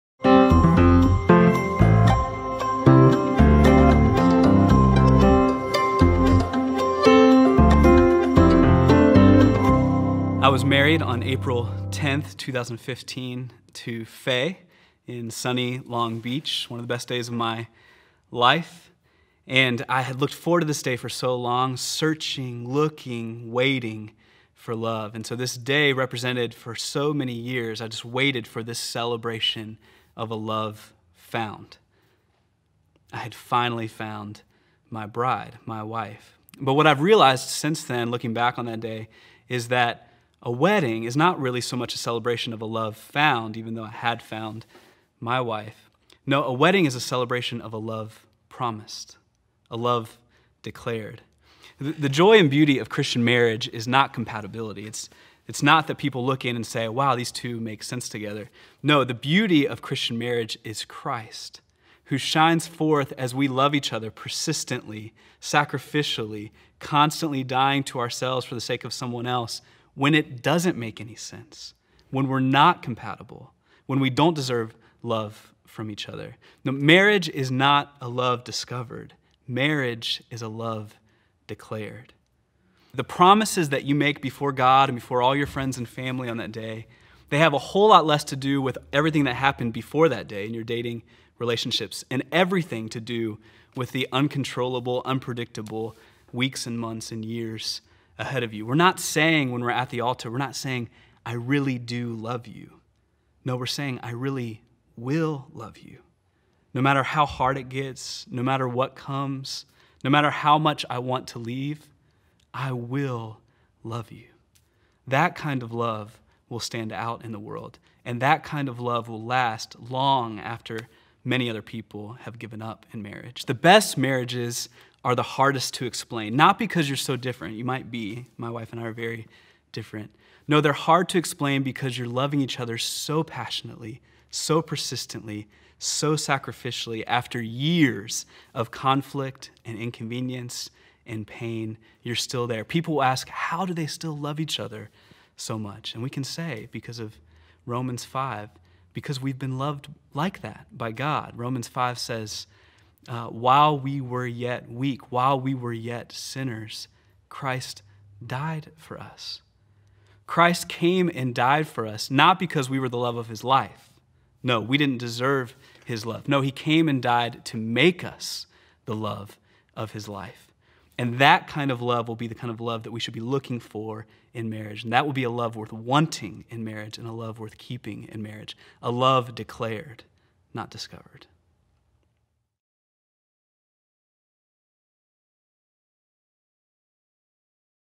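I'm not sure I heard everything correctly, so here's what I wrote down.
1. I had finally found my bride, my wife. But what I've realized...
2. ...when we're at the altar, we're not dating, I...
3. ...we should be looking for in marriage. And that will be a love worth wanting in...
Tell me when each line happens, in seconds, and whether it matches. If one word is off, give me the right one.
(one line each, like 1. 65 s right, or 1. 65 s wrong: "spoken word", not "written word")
1. 33 s right
2. 99 s wrong: "saying", not "dating"
3. 172 s right.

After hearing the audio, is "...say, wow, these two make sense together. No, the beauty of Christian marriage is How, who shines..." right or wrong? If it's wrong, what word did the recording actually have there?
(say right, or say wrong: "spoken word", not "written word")
wrong: "Christ", not "How".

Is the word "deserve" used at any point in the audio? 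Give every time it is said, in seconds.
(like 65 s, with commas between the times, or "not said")
74 s, 164 s.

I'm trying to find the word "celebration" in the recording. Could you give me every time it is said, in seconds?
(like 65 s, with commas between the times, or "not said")
28 s, 41 s, 47 s.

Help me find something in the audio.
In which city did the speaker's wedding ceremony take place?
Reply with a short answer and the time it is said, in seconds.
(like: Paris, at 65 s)
Long Beach, at 15 s.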